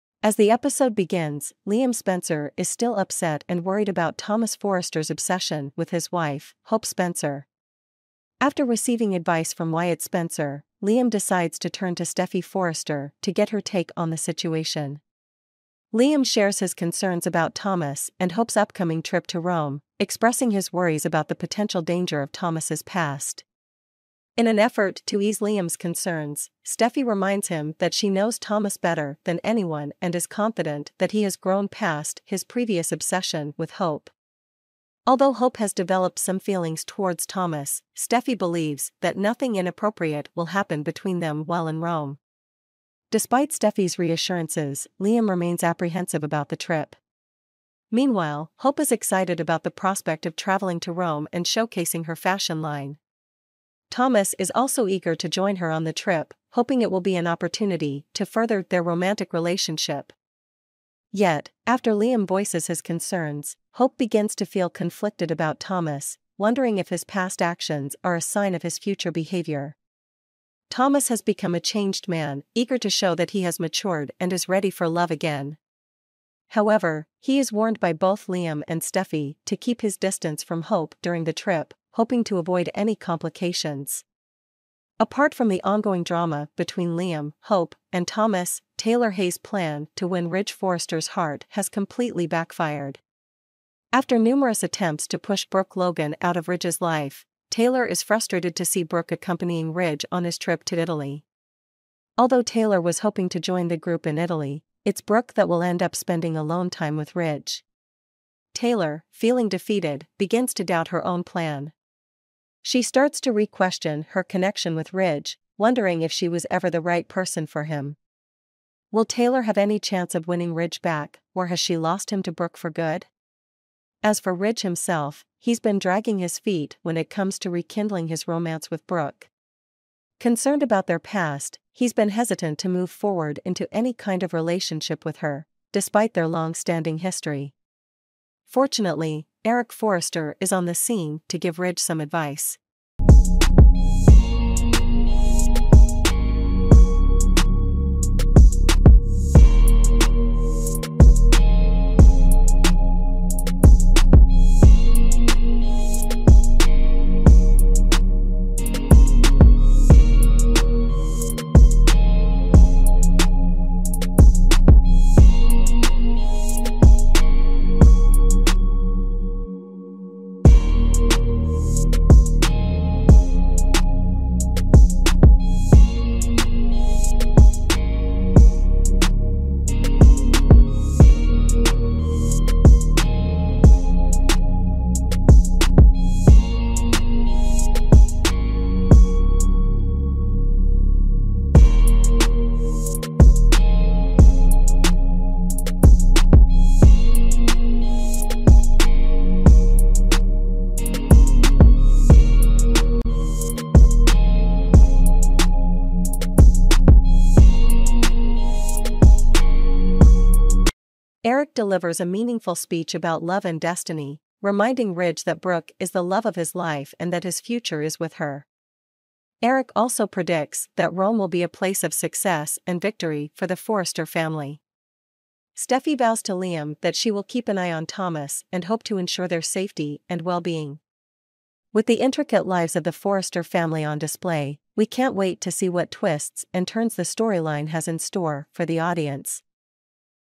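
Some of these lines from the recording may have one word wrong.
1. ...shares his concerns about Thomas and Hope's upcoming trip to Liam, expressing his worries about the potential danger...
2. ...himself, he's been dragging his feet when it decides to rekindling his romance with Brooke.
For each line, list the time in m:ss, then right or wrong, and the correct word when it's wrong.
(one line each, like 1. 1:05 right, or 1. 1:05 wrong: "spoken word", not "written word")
1. 0:16 wrong: "Rome", not "Liam"
2. 2:04 wrong: "comes", not "decides".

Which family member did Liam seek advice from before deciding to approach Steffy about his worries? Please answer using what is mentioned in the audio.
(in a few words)
Wyatt Spencer.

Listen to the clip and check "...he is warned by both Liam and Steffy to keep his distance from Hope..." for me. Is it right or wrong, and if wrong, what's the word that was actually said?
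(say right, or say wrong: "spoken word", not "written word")
right.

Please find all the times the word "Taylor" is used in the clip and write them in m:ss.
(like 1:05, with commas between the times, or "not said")
1:28, 1:37, 1:42, 1:48, 1:59.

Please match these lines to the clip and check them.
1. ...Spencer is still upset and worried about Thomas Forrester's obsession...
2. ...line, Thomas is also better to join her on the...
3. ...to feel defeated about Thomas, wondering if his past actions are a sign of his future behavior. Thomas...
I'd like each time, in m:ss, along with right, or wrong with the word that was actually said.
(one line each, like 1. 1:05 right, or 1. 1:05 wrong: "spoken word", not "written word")
1. 0:01 right
2. 0:52 wrong: "eager", not "better"
3. 1:04 wrong: "conflicted", not "defeated".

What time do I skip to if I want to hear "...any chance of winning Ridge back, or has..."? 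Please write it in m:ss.
1:59.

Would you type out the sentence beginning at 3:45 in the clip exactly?
Steffy vows to Liam that she will keep an eye on Thomas and hope to ensure their safety and well being.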